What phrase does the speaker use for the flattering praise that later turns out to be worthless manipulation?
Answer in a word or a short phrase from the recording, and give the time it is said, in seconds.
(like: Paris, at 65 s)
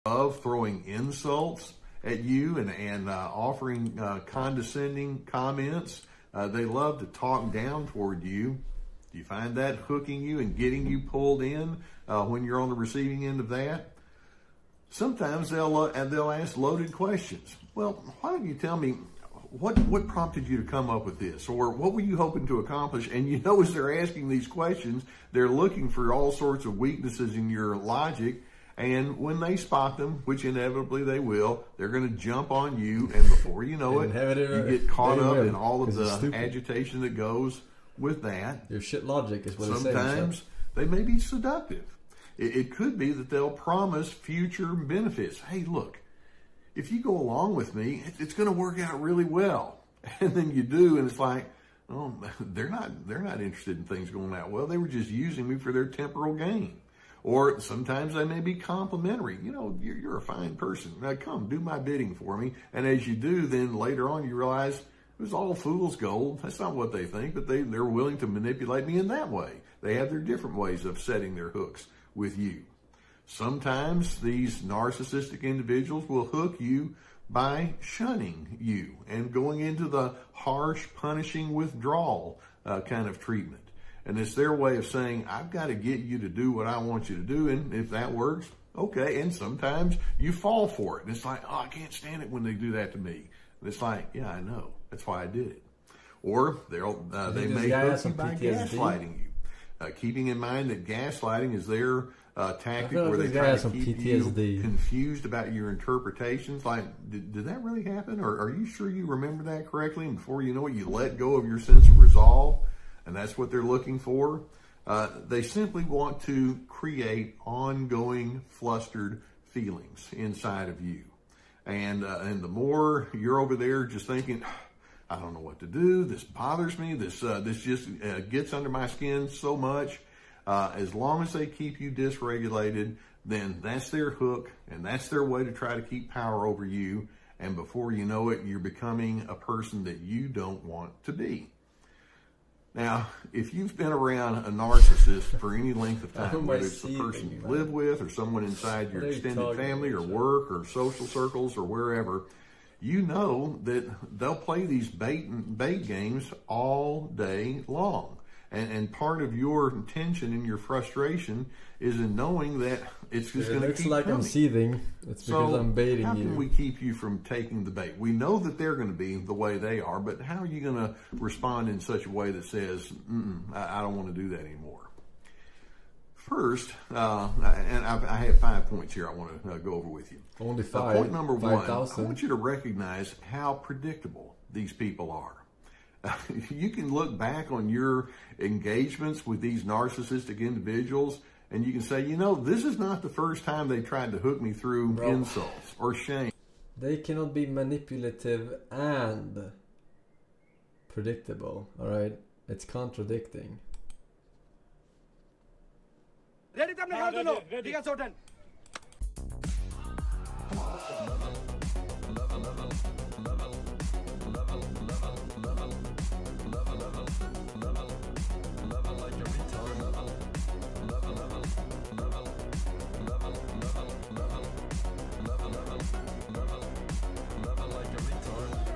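fool's gold, at 65 s.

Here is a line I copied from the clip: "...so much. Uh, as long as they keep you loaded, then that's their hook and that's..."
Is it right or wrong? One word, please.
wrong.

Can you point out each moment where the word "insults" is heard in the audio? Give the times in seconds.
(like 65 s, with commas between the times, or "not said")
0 s, 195 s.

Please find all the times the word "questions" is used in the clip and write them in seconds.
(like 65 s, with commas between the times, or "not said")
16 s, 24 s.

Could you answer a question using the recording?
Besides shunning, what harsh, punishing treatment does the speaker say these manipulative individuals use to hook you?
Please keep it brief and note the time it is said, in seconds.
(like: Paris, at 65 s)
withdrawal, at 81 s.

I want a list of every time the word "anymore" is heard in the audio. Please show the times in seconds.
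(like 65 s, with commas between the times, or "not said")
174 s.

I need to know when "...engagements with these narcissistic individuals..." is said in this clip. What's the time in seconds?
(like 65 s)
188 s.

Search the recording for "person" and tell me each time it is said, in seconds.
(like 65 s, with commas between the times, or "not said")
60 s, 139 s, 146 s.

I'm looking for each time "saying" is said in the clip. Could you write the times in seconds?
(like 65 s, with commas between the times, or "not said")
40 s, 84 s.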